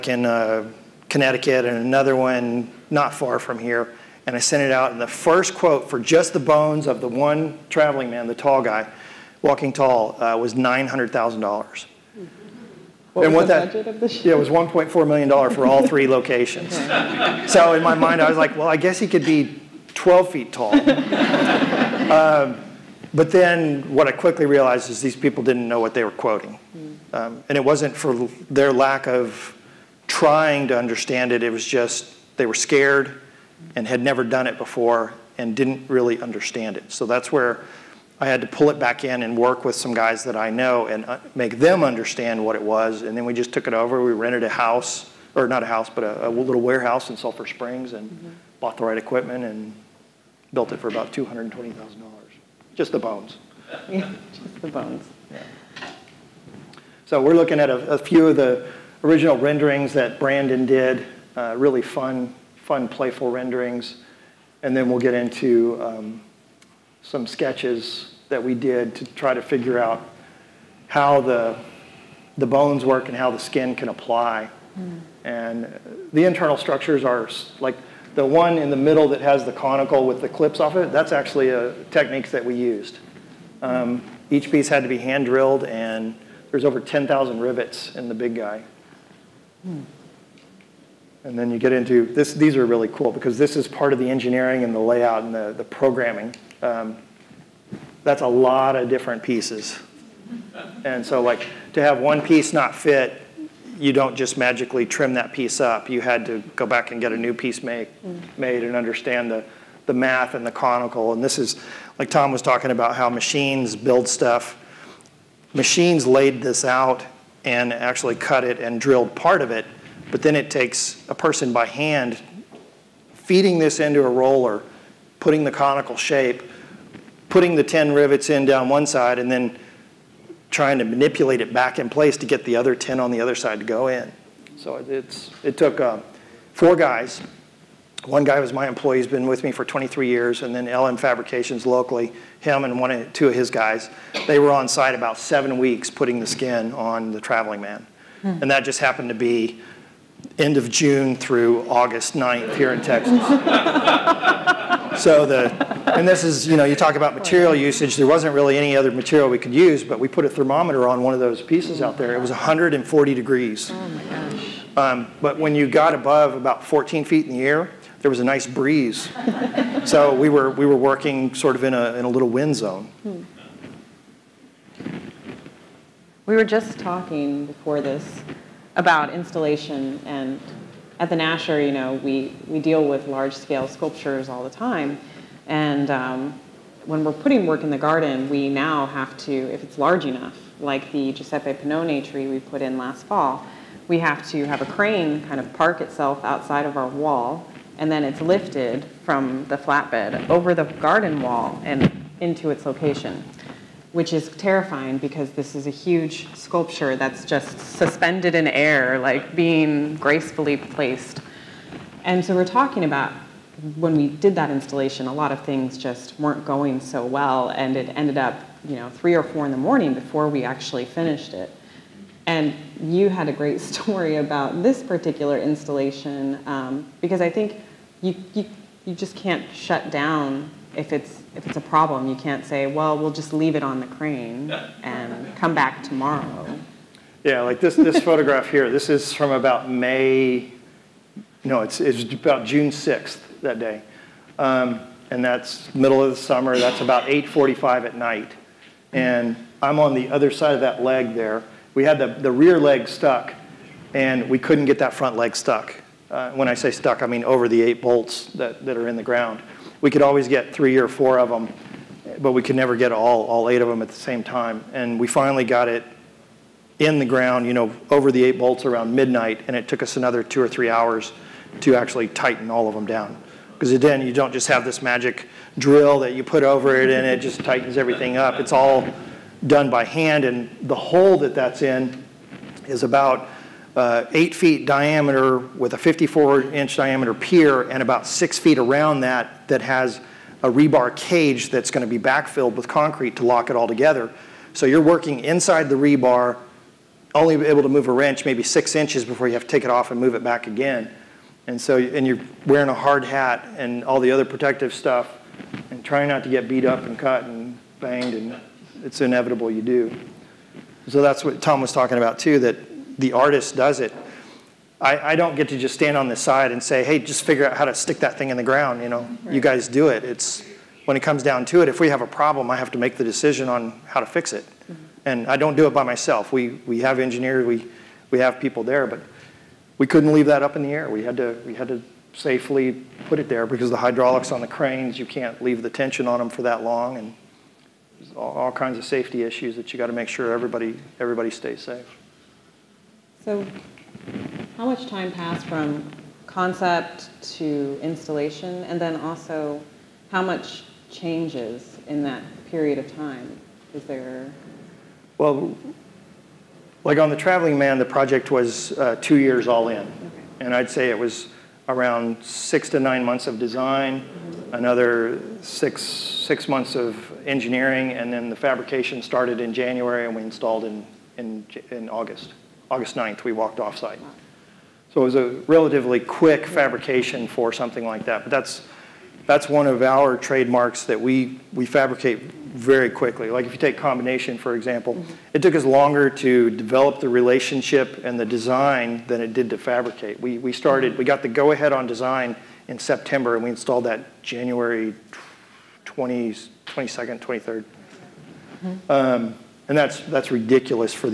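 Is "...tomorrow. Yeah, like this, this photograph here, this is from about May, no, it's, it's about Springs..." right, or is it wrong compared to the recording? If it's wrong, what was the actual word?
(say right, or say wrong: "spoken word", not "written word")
wrong: "June", not "Springs".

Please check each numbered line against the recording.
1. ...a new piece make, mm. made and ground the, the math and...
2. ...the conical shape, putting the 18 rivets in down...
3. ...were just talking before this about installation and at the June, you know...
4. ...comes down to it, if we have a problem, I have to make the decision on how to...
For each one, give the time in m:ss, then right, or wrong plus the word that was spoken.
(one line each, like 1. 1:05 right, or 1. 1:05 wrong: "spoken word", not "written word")
1. 1:47 wrong: "understand", not "ground"
2. 2:05 wrong: "10", not "18"
3. 2:56 wrong: "Nasher", not "June"
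4. 5:21 right.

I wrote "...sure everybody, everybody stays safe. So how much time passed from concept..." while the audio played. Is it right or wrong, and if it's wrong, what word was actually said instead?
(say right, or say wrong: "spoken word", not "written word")
right.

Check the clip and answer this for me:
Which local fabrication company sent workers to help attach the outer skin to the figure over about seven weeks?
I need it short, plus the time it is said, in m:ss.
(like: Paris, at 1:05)
LM Fabrications, at 2:20.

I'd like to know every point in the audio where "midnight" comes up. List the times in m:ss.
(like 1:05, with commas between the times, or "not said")
4:28.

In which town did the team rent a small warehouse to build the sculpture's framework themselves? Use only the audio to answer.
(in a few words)
Sulphur Springs.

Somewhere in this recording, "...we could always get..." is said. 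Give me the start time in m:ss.
4:19.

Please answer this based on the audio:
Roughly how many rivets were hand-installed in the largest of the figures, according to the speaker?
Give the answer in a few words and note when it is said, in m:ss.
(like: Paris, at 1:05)
Over 10,000, at 1:26.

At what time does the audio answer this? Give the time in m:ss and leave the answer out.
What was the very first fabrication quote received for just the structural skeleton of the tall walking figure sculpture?
0:10.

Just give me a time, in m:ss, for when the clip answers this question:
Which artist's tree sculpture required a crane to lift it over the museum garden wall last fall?
3:11.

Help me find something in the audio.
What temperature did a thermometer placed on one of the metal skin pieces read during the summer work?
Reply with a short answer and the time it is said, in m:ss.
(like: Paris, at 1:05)
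140 degrees, at 2:42.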